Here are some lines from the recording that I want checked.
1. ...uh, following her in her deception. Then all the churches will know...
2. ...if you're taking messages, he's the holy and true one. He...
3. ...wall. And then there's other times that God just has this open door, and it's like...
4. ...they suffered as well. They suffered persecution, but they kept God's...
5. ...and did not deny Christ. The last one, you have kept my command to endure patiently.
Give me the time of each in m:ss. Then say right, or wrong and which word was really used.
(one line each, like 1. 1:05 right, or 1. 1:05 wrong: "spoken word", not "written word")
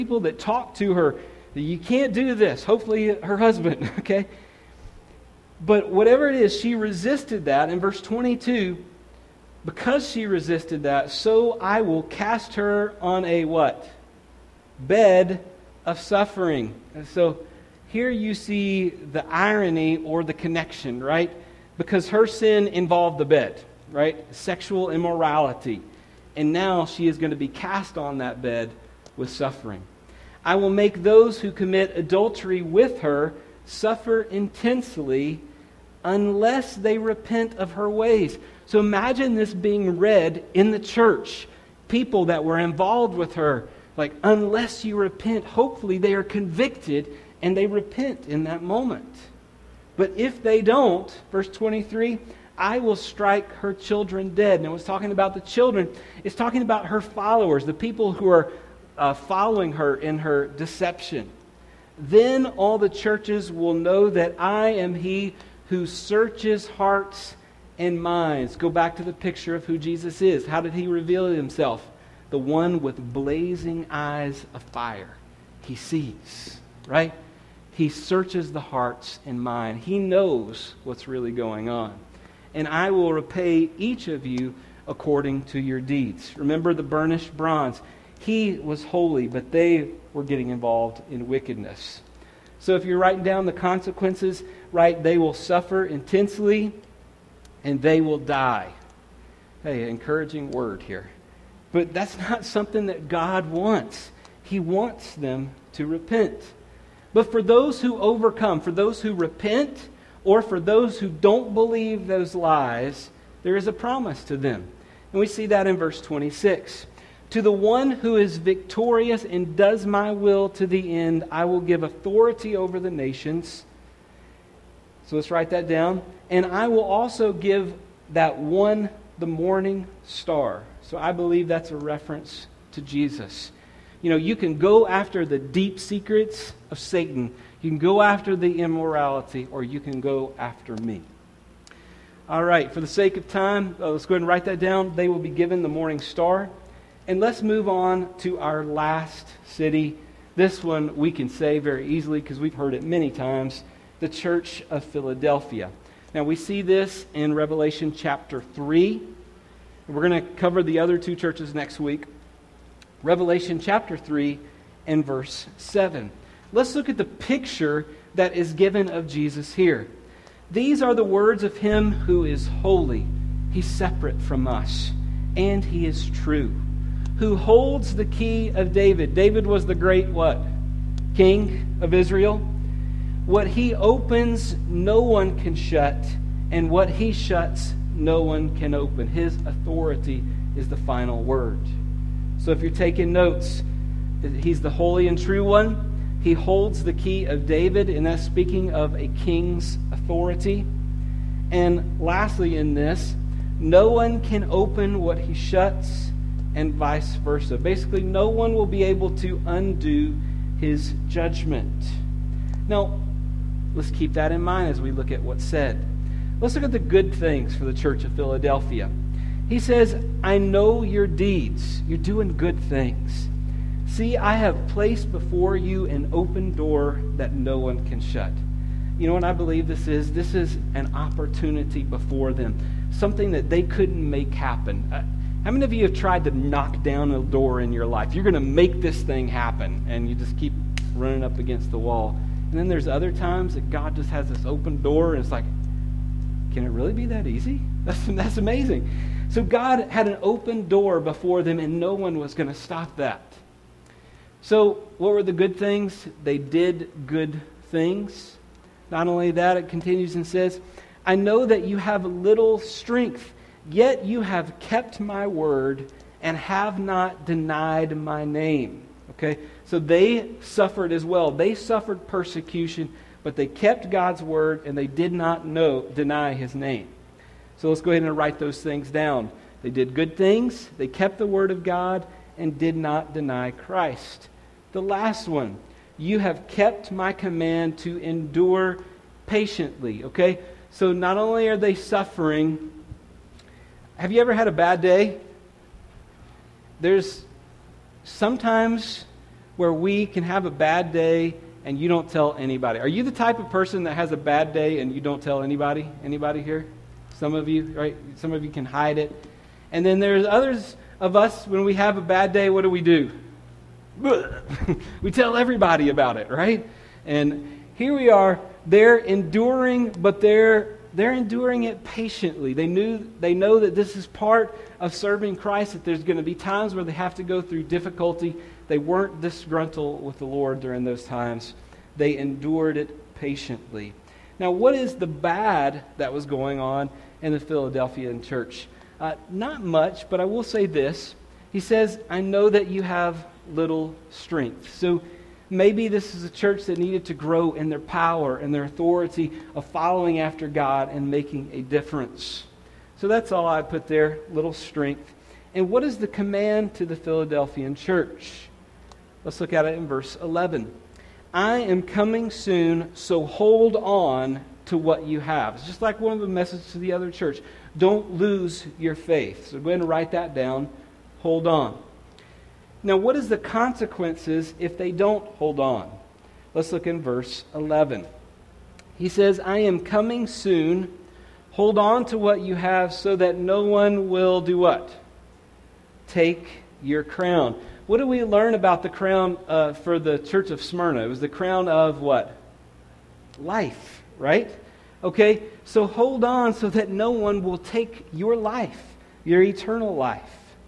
1. 0:58 right
2. 3:12 wrong: "notes", not "messages"
3. 4:01 right
4. 4:29 right
5. 4:42 right.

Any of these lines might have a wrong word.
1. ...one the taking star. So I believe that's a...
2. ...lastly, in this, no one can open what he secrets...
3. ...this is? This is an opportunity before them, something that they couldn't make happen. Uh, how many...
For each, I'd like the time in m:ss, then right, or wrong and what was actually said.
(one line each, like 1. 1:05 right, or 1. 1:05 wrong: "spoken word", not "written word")
1. 2:08 wrong: "morning", not "taking"
2. 3:21 wrong: "shuts", not "secrets"
3. 3:49 right.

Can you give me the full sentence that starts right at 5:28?
They weren't disgruntled with the Lord during those times, they endured it patiently.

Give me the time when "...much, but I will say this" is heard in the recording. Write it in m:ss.
5:39.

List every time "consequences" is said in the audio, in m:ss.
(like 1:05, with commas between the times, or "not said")
1:33, 6:13.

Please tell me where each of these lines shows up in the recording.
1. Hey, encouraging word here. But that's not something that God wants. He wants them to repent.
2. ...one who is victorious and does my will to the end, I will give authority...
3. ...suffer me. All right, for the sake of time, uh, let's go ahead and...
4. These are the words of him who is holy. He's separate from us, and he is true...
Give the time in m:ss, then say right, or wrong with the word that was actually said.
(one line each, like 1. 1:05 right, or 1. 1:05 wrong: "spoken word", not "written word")
1. 1:39 right
2. 1:57 right
3. 2:20 wrong: "after", not "suffer"
4. 2:50 right.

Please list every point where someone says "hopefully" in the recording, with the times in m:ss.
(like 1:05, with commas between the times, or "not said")
0:02, 0:45.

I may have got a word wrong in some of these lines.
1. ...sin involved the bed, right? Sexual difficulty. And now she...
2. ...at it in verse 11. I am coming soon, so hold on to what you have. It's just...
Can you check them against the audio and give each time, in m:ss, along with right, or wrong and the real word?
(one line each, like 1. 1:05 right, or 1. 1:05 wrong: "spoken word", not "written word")
1. 0:22 wrong: "immorality", not "difficulty"
2. 5:59 right.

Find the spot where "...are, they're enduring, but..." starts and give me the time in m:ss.
5:18.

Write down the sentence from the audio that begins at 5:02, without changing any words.
Are you the type of person that has a bad day and you don't tell anybody?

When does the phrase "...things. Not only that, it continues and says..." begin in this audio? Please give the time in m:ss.
4:17.